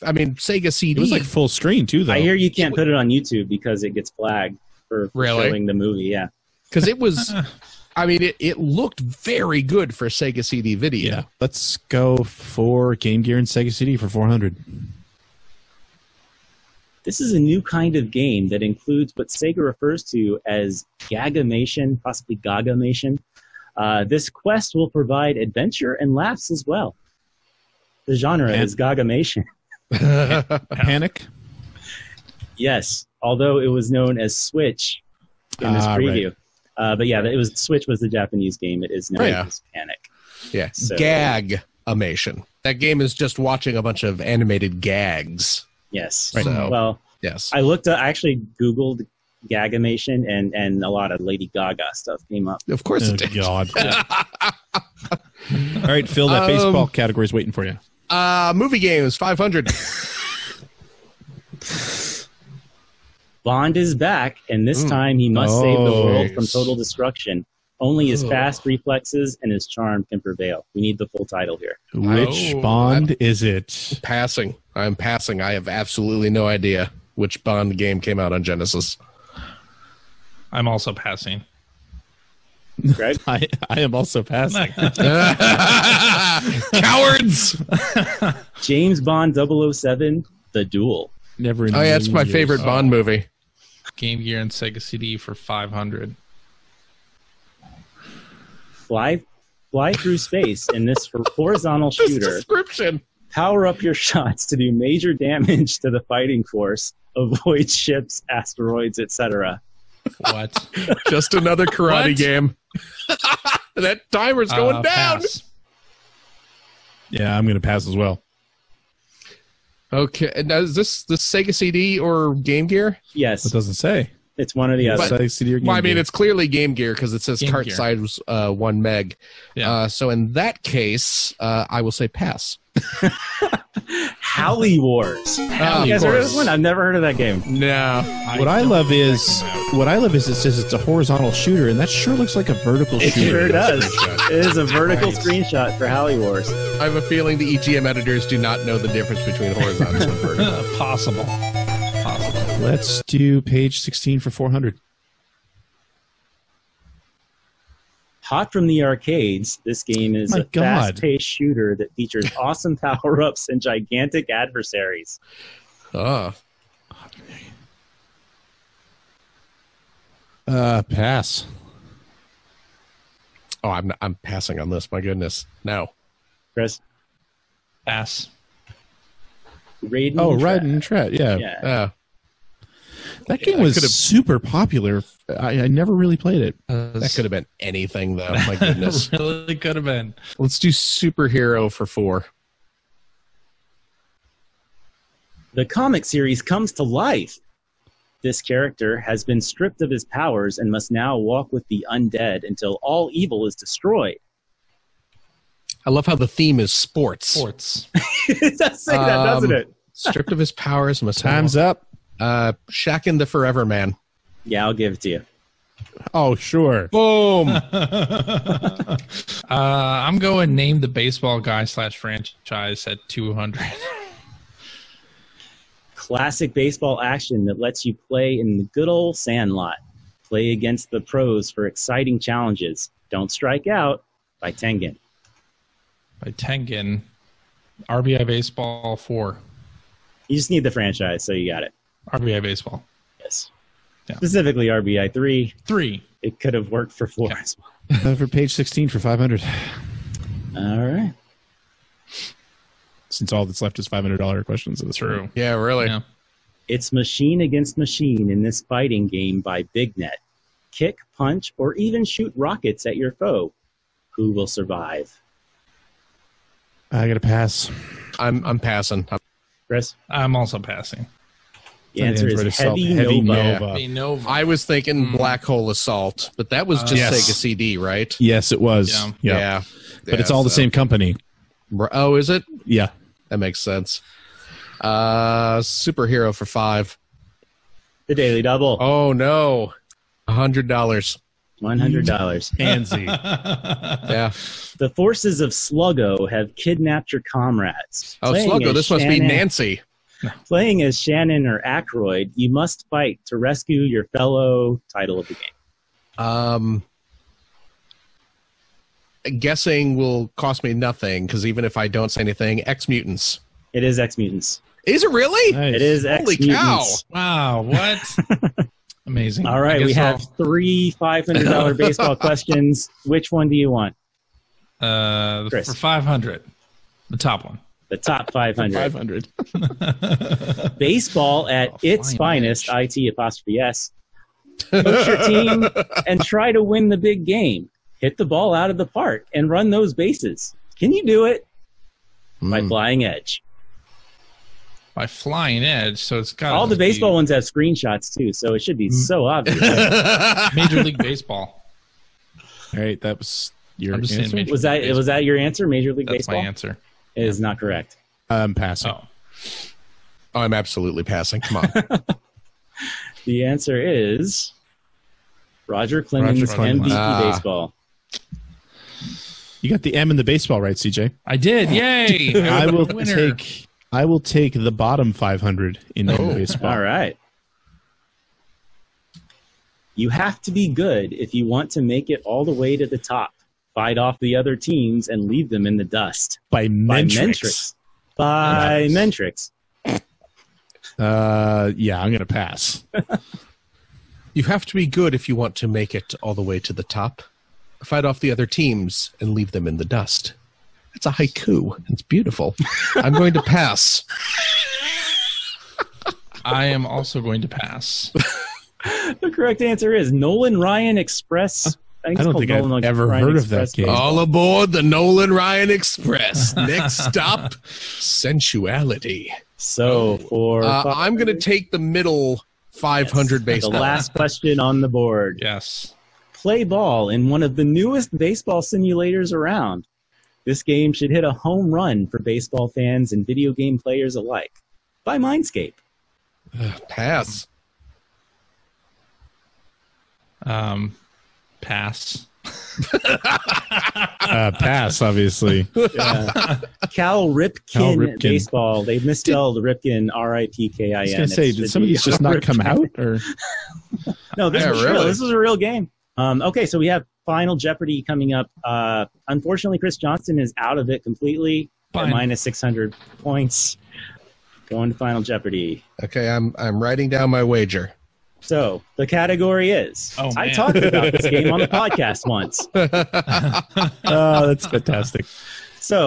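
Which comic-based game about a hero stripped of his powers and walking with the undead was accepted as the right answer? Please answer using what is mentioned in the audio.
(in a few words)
Chakan the Forever Man.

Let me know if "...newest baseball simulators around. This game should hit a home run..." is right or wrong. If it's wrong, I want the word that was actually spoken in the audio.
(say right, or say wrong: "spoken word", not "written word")
right.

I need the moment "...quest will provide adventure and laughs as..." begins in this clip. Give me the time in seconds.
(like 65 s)
24 s.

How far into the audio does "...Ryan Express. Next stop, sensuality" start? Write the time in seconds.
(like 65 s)
415 s.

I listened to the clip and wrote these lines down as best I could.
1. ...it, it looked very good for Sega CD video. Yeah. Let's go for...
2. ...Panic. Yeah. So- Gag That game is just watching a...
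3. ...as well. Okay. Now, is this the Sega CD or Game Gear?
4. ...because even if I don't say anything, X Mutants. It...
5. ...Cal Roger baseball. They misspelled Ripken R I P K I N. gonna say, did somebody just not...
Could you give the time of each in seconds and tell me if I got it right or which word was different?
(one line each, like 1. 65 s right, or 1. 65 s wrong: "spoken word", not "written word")
1. 8 s right
2. 39 s right
3. 117 s right
4. 311 s right
5. 447 s wrong: "Ripken", not "Roger".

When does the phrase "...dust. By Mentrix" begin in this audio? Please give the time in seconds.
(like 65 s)
385 s.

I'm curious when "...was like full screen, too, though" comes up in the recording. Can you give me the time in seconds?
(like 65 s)
1 s.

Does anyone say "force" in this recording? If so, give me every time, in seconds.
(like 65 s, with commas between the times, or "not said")
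106 s, 294 s.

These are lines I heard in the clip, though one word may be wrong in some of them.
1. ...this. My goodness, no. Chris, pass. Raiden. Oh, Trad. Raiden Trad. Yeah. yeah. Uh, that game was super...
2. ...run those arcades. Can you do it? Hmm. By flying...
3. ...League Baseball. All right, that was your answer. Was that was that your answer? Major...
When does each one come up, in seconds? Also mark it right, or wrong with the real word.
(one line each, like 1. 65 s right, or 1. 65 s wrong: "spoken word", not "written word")
1. 174 s right
2. 339 s wrong: "bases", not "arcades"
3. 350 s right.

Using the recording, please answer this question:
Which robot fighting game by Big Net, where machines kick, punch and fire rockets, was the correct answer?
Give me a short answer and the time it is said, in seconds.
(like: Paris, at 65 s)
Heavy Nova, at 272 s.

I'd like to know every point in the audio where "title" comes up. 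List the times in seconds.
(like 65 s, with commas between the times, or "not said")
71 s, 304 s.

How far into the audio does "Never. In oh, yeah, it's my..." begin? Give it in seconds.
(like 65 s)
91 s.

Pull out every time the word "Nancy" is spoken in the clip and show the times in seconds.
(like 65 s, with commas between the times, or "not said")
292 s, 299 s.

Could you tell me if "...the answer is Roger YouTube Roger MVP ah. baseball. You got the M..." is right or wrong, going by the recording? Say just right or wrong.
wrong.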